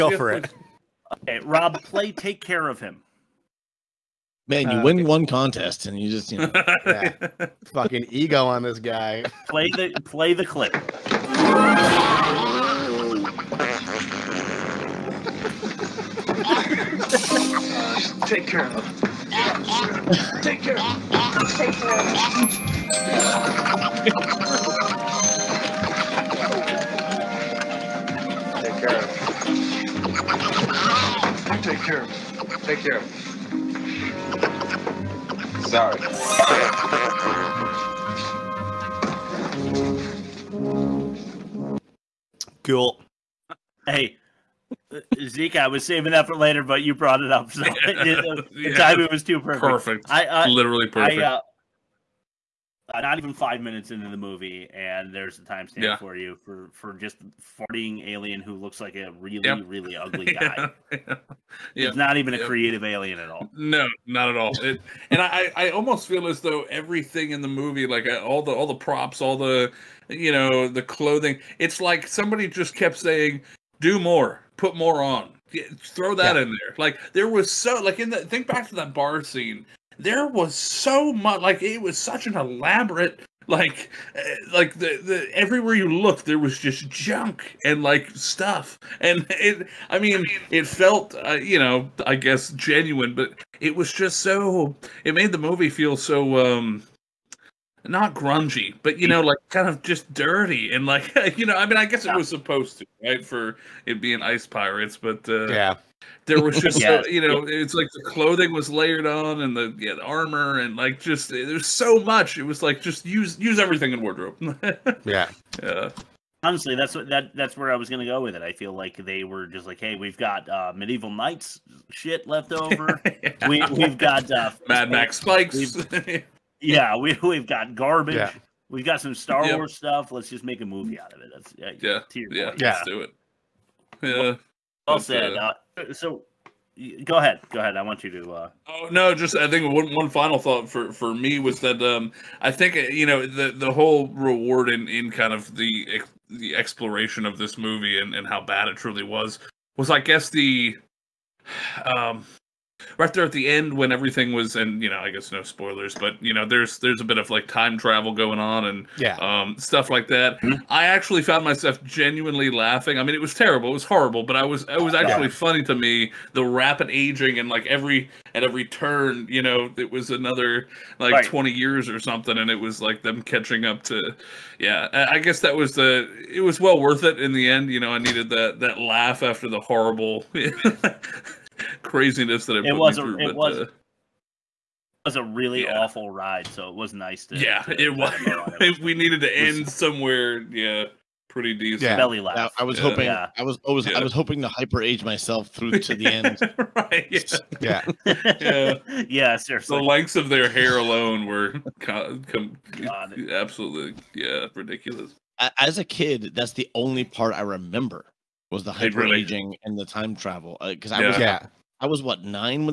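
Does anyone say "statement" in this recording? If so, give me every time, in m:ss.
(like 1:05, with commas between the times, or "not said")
not said.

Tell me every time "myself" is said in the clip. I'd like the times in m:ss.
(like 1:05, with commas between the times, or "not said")
2:41, 3:15.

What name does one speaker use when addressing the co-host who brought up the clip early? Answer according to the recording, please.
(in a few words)
Zeke.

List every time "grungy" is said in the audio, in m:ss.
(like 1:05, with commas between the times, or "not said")
1:38.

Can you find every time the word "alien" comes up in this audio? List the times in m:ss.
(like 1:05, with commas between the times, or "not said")
0:58, 1:02.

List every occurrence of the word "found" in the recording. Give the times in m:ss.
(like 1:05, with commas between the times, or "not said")
2:41.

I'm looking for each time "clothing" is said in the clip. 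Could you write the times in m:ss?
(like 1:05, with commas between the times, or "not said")
1:10, 1:48.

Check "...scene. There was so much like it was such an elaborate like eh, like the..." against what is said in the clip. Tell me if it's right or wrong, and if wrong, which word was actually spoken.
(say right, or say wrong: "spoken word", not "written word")
right.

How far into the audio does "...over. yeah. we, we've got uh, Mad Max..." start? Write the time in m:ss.
2:02.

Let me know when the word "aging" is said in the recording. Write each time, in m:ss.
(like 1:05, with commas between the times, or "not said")
2:46, 3:29.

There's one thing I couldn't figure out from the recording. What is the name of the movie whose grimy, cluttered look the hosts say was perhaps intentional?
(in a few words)
Ice Pirates.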